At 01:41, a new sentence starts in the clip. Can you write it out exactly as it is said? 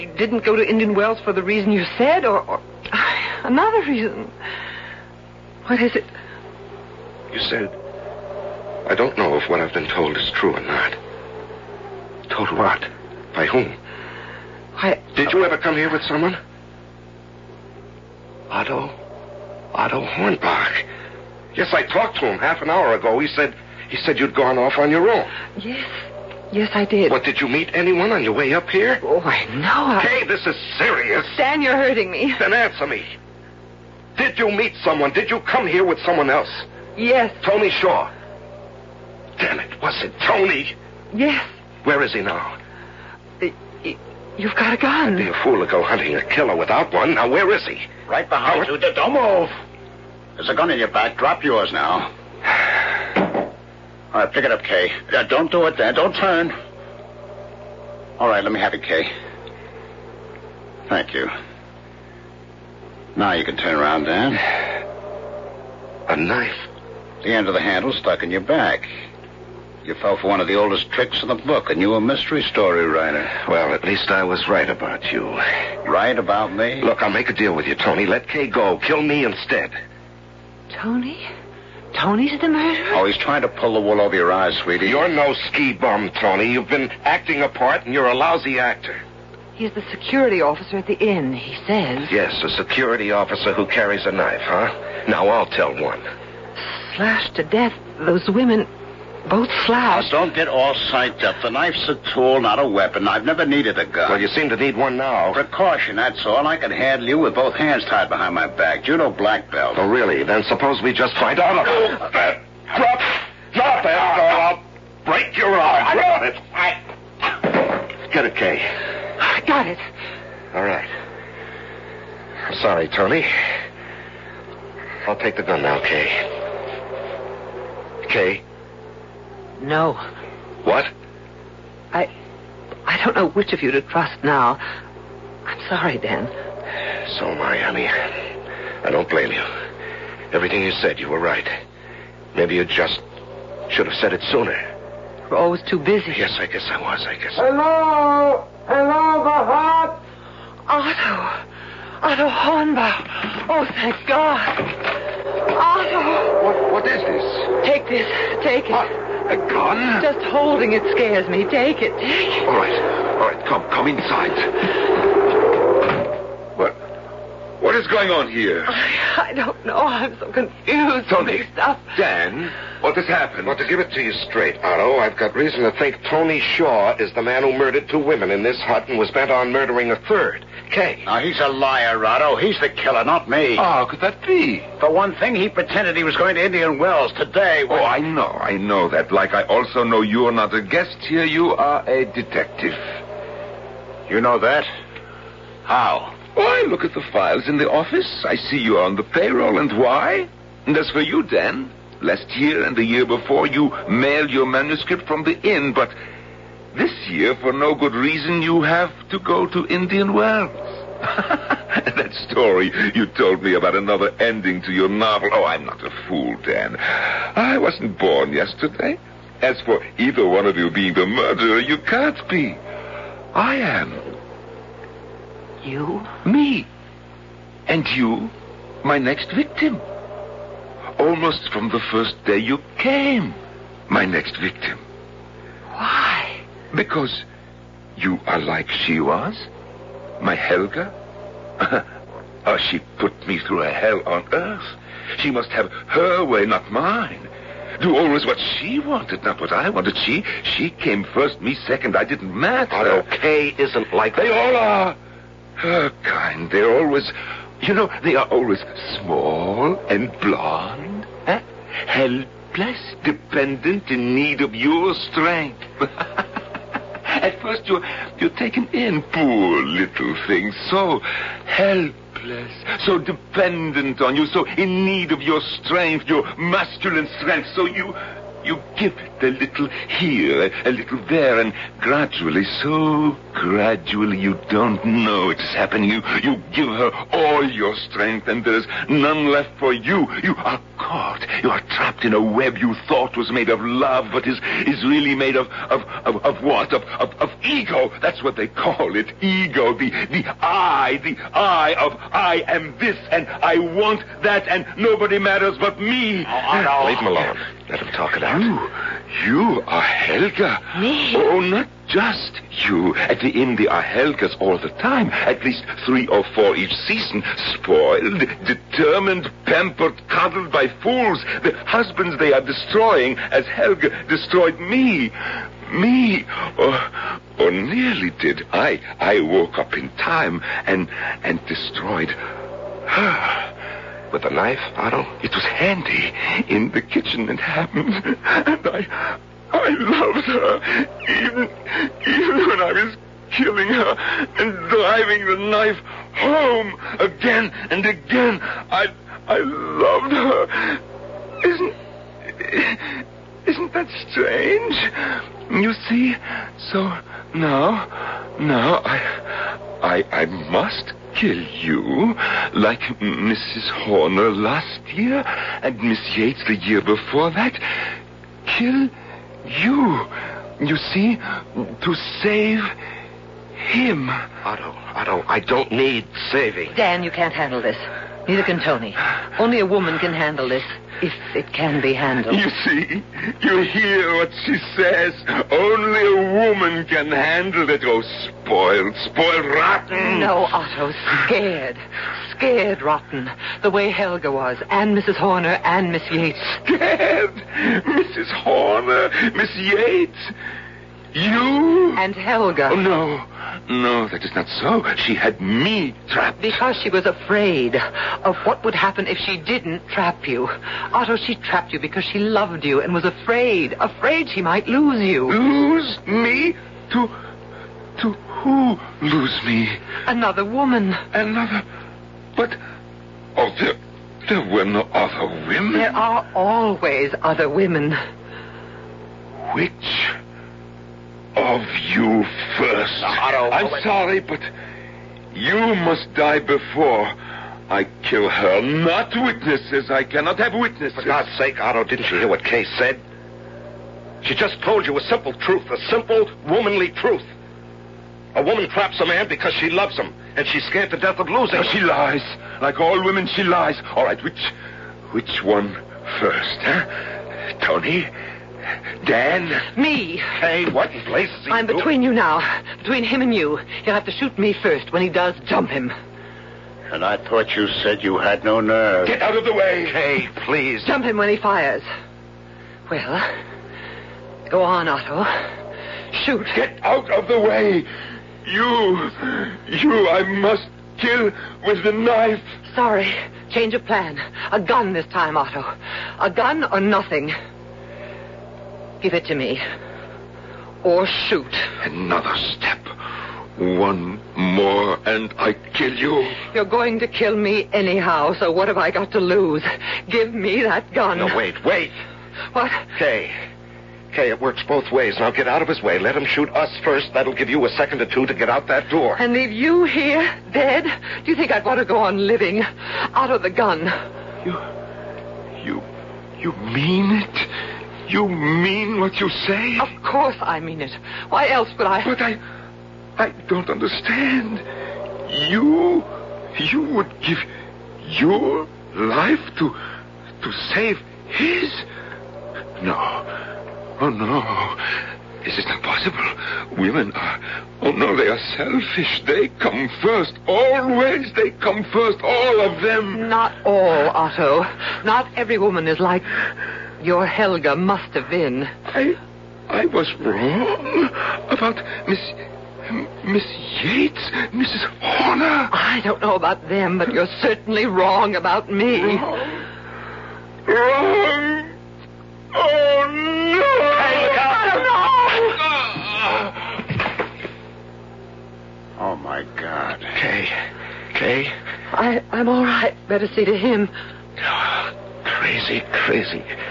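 The knife's a tool, not a weapon.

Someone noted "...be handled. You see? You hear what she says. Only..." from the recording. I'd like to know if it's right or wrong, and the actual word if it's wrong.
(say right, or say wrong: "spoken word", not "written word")
right.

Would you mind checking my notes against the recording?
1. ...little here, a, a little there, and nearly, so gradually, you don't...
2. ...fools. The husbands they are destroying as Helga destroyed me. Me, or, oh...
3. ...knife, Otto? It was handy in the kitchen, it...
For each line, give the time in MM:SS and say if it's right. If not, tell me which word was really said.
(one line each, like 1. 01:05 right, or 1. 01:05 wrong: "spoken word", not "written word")
1. 04:39 wrong: "gradually", not "nearly"
2. 05:20 right
3. 05:34 right.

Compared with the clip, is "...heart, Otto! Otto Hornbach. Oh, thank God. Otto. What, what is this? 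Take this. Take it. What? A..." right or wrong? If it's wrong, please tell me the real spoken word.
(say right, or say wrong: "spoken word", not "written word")
right.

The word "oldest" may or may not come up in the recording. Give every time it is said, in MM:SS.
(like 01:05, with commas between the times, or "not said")
01:10.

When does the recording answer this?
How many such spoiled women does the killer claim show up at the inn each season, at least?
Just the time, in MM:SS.
05:15.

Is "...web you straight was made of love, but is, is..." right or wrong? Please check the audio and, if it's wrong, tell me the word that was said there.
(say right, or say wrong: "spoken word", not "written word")
wrong: "thought", not "straight".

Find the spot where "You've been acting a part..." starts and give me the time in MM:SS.
01:26.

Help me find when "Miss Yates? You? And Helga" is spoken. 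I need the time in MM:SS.
06:39.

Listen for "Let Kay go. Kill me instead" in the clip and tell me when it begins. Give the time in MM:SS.
01:18.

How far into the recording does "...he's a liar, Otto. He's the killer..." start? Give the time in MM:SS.
03:01.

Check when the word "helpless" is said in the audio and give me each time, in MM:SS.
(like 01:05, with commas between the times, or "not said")
04:21, 04:31.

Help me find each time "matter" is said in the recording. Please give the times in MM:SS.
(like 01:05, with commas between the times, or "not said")
04:12, 05:05.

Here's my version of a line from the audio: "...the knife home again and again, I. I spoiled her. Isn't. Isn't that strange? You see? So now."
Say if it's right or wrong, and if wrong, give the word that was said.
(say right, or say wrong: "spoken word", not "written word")
wrong: "loved", not "spoiled".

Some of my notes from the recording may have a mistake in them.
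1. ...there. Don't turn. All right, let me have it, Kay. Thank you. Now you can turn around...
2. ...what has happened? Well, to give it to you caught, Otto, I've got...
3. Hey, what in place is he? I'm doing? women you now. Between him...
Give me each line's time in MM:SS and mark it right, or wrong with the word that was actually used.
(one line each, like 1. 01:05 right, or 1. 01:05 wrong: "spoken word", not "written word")
1. 00:55 right
2. 02:52 wrong: "straight", not "caught"
3. 07:40 wrong: "between", not "women".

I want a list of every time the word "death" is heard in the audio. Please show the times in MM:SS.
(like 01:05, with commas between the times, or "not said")
01:37, 07:30.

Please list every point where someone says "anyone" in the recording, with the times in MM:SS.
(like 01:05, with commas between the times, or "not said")
00:27.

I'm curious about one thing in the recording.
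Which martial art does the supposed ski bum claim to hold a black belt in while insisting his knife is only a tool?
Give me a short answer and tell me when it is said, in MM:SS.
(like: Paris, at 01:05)
Judo, at 01:48.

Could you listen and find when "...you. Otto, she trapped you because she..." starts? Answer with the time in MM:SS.
06:50.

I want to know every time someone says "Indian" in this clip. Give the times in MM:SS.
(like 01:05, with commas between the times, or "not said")
00:00, 03:06, 03:29.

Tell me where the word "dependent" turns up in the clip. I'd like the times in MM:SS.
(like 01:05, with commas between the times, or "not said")
04:23, 04:32.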